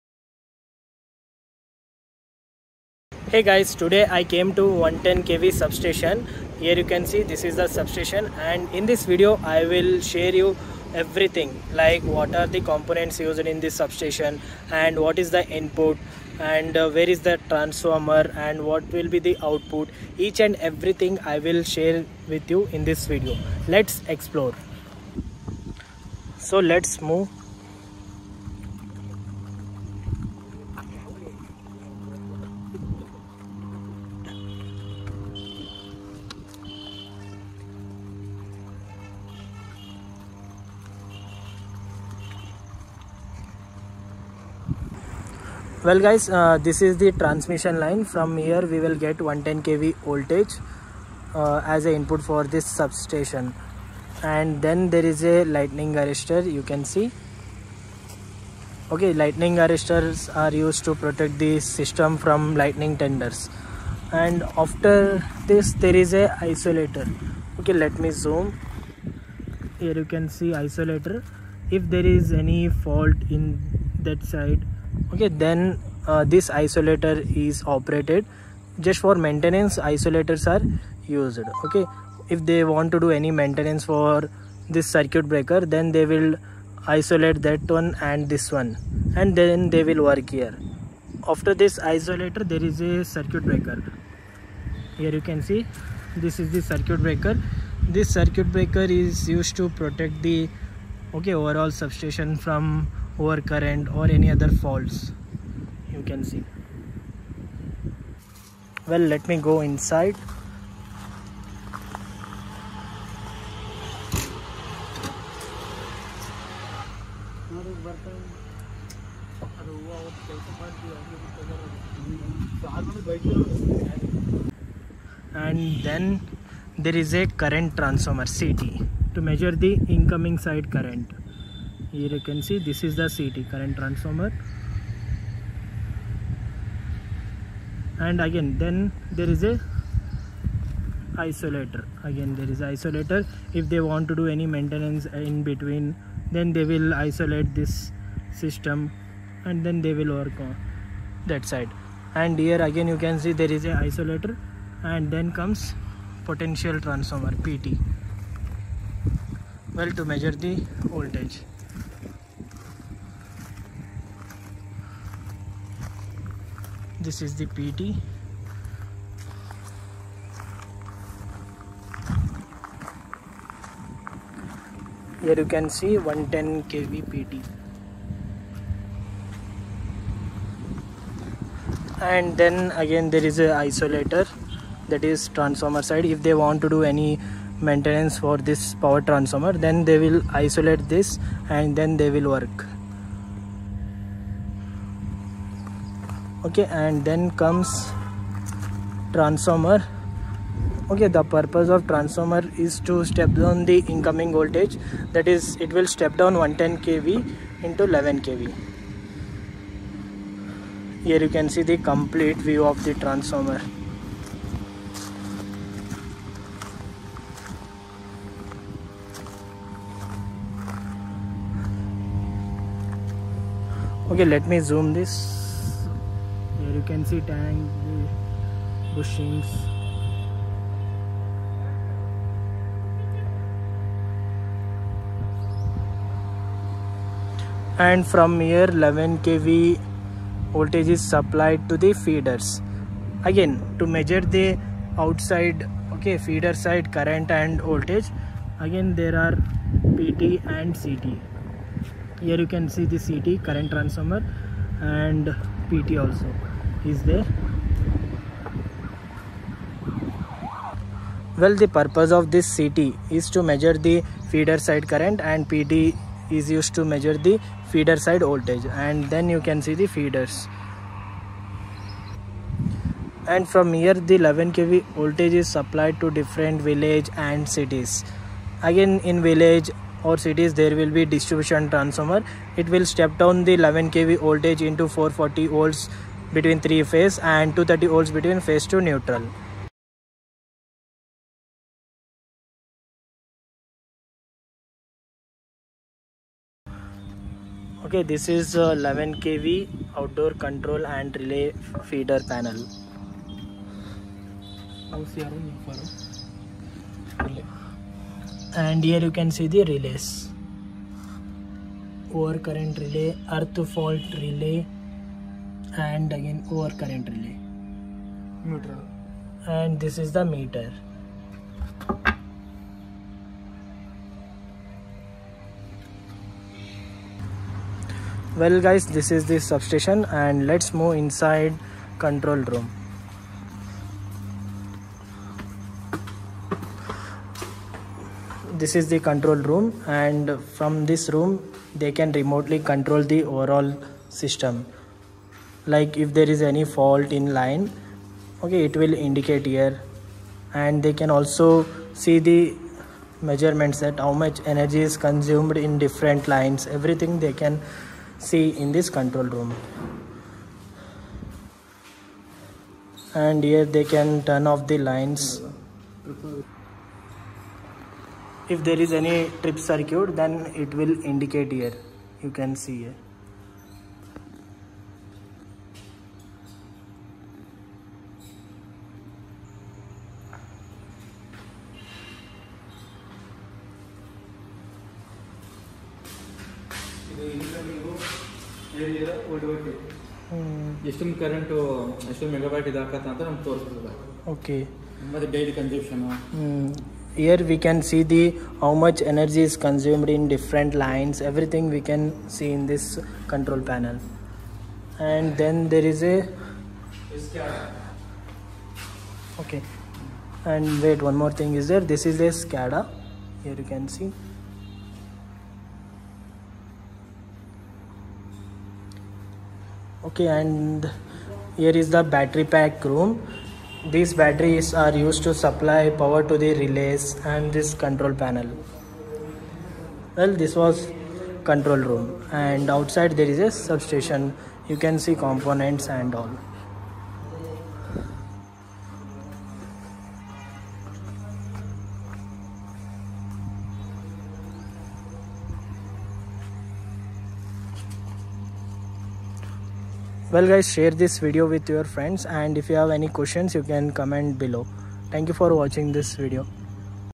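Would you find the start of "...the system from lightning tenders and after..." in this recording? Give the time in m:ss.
1:01.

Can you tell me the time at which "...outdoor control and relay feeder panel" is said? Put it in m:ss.
4:59.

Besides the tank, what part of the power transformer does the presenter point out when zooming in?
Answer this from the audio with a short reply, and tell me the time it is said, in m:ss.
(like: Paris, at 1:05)
bushings, at 3:48.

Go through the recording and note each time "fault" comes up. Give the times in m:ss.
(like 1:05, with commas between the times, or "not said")
1:12, 1:44, 5:13, 5:46.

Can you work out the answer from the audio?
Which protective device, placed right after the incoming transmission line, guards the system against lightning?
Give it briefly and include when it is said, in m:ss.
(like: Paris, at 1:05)
lightning arrestor, at 0:55.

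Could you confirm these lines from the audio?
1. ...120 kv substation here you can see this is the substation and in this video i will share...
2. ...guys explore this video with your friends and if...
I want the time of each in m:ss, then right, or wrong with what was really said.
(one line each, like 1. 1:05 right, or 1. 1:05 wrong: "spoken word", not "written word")
1. 0:04 wrong: "110", not "120"
2. 7:30 wrong: "share", not "explore".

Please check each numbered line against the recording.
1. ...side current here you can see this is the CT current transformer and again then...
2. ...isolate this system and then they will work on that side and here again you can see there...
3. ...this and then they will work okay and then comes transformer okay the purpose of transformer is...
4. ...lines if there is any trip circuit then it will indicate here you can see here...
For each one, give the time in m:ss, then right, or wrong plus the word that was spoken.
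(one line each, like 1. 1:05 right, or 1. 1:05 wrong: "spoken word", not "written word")
1. 2:10 right
2. 2:26 right
3. 3:10 right
4. 6:04 right.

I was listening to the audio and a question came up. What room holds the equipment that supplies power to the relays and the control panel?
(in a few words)
battery pack room.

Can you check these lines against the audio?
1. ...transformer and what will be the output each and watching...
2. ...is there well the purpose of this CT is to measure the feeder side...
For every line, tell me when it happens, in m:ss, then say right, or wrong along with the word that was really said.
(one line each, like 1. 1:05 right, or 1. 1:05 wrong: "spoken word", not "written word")
1. 0:17 wrong: "everything", not "watching"
2. 4:16 right.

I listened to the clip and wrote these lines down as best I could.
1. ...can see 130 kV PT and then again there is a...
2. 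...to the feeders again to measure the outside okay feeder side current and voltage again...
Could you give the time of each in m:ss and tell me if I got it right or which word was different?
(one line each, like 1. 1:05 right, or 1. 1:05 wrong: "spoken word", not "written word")
1. 2:55 wrong: "110", not "130"
2. 4:01 right.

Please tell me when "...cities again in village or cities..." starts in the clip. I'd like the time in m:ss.
4:37.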